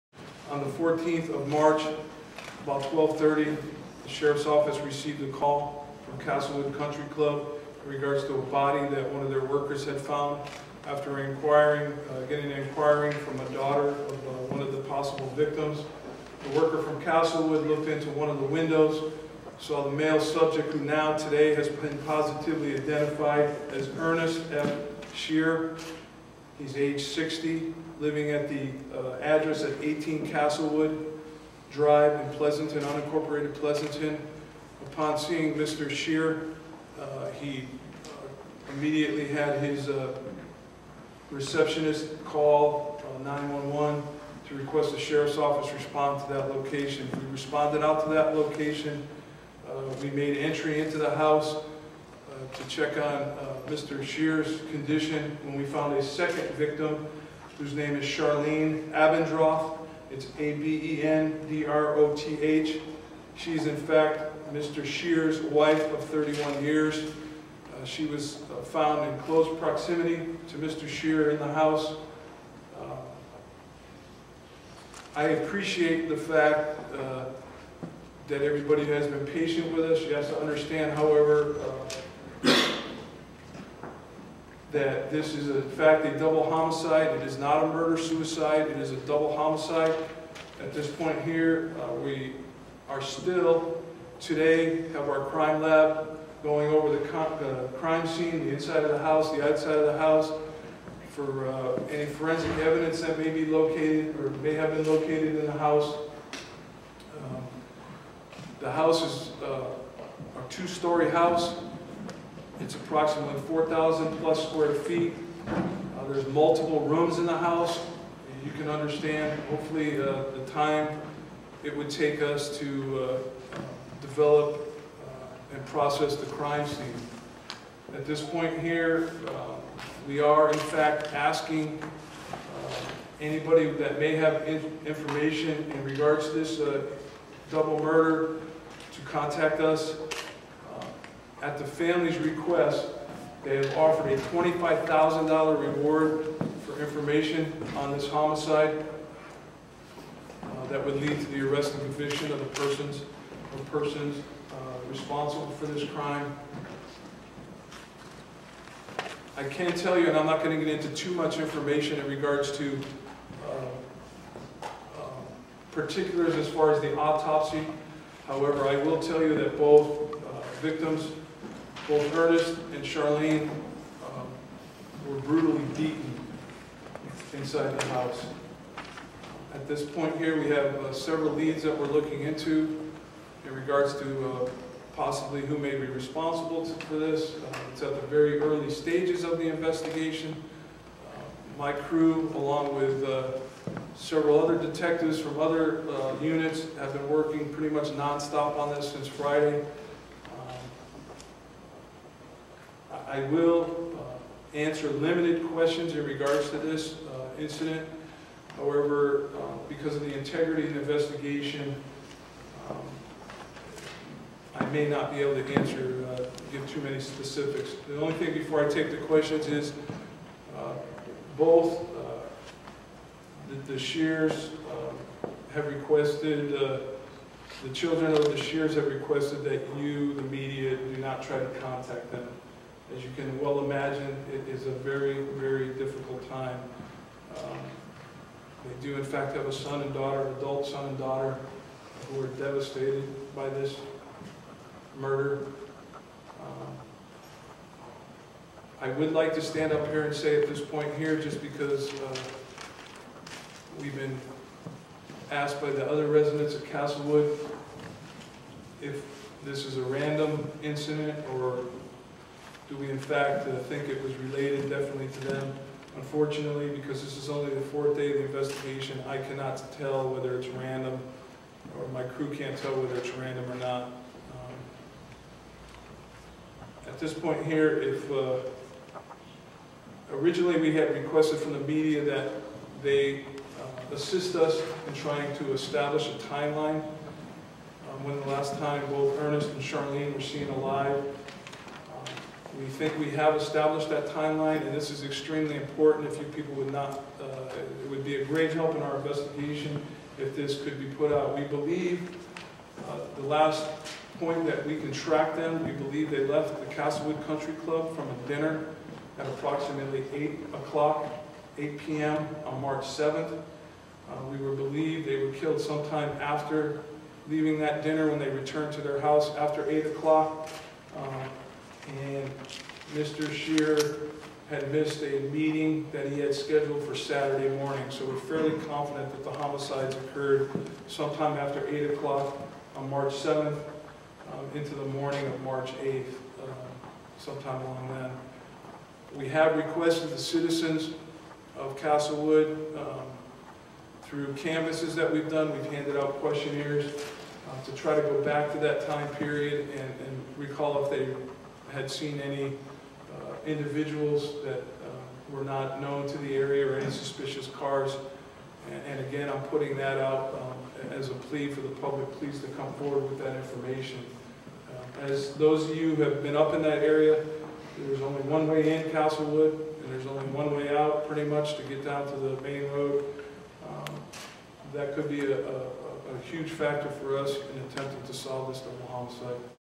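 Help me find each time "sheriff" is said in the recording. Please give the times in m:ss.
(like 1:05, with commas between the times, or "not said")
0:04, 0:44.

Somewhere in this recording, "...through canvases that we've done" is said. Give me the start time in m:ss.
5:44.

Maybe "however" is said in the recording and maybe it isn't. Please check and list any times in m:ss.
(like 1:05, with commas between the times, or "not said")
1:20, 2:48, 3:28.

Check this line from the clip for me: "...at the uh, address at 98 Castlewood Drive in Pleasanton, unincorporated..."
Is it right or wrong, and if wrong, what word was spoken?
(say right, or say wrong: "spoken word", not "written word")
wrong: "18", not "98".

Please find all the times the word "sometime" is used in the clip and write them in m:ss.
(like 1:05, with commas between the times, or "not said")
5:15, 5:30, 5:37.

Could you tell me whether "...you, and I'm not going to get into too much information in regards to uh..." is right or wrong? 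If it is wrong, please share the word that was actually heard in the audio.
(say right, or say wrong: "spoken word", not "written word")
right.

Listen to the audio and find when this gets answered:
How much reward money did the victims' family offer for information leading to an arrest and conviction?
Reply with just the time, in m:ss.
2:24.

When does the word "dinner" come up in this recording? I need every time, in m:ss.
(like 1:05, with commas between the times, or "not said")
5:08, 5:17.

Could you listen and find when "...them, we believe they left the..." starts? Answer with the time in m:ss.
5:05.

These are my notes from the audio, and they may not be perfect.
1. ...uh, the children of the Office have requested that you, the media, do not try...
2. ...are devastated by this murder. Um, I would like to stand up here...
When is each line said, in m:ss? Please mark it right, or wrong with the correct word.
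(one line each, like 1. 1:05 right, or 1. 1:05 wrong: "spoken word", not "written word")
1. 3:46 wrong: "Scherers", not "Office"
2. 4:02 right.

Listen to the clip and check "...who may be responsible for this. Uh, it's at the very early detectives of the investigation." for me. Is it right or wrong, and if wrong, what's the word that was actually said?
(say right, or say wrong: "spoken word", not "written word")
wrong: "stages", not "detectives".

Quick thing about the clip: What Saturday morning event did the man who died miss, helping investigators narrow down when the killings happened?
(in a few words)
a meeting.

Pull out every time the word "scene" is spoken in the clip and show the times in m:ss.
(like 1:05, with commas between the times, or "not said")
1:38, 2:06.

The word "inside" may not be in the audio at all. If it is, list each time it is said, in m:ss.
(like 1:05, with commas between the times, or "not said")
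1:38, 2:57.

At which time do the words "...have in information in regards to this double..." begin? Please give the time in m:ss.
2:14.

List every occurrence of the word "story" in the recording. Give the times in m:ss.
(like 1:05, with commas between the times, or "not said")
1:50.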